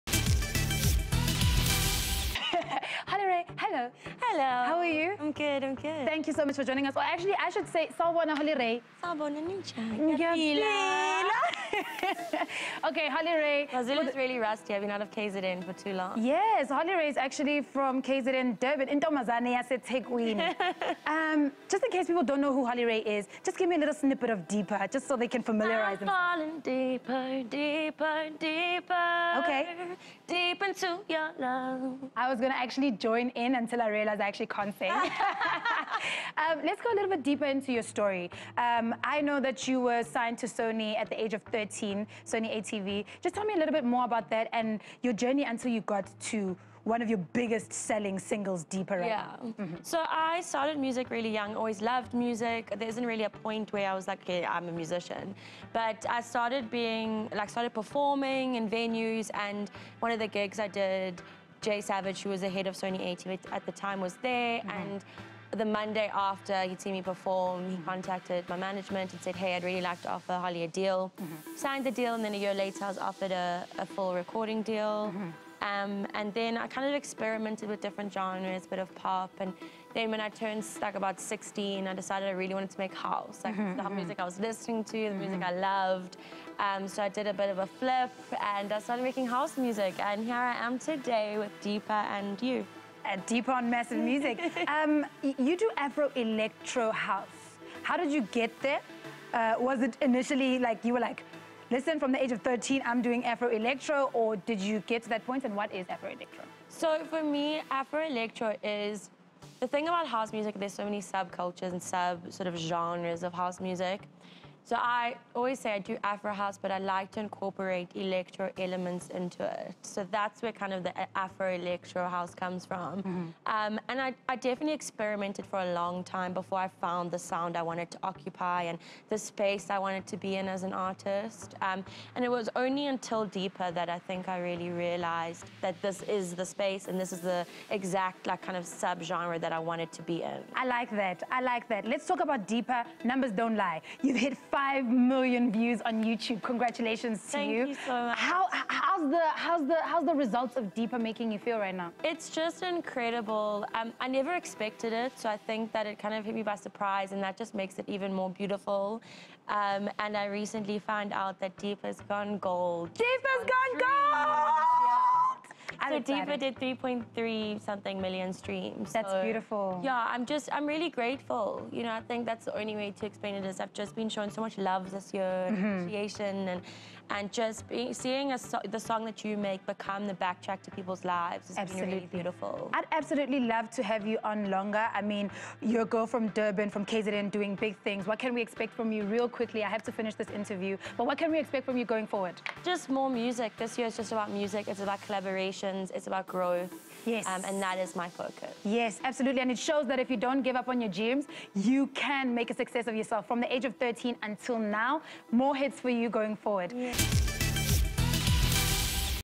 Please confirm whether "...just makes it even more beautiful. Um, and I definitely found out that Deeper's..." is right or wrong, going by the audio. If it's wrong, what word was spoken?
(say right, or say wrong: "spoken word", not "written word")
wrong: "recently", not "definitely".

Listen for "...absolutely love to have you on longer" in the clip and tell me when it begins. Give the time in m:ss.
3:02.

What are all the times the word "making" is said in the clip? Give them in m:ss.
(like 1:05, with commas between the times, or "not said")
1:29, 2:30.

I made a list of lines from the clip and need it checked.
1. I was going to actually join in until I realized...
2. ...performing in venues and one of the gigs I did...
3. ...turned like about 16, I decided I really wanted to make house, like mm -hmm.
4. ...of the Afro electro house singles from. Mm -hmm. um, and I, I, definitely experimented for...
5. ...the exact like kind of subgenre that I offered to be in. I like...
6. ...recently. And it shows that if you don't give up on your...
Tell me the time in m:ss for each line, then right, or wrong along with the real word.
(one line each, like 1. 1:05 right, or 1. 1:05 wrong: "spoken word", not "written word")
1. 0:32 right
2. 0:57 right
3. 1:20 right
4. 2:00 wrong: "comes", not "singles"
5. 2:17 wrong: "wanted", not "offered"
6. 3:19 wrong: "absolutely", not "recently".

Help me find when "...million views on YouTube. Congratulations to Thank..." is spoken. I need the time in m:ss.
2:24.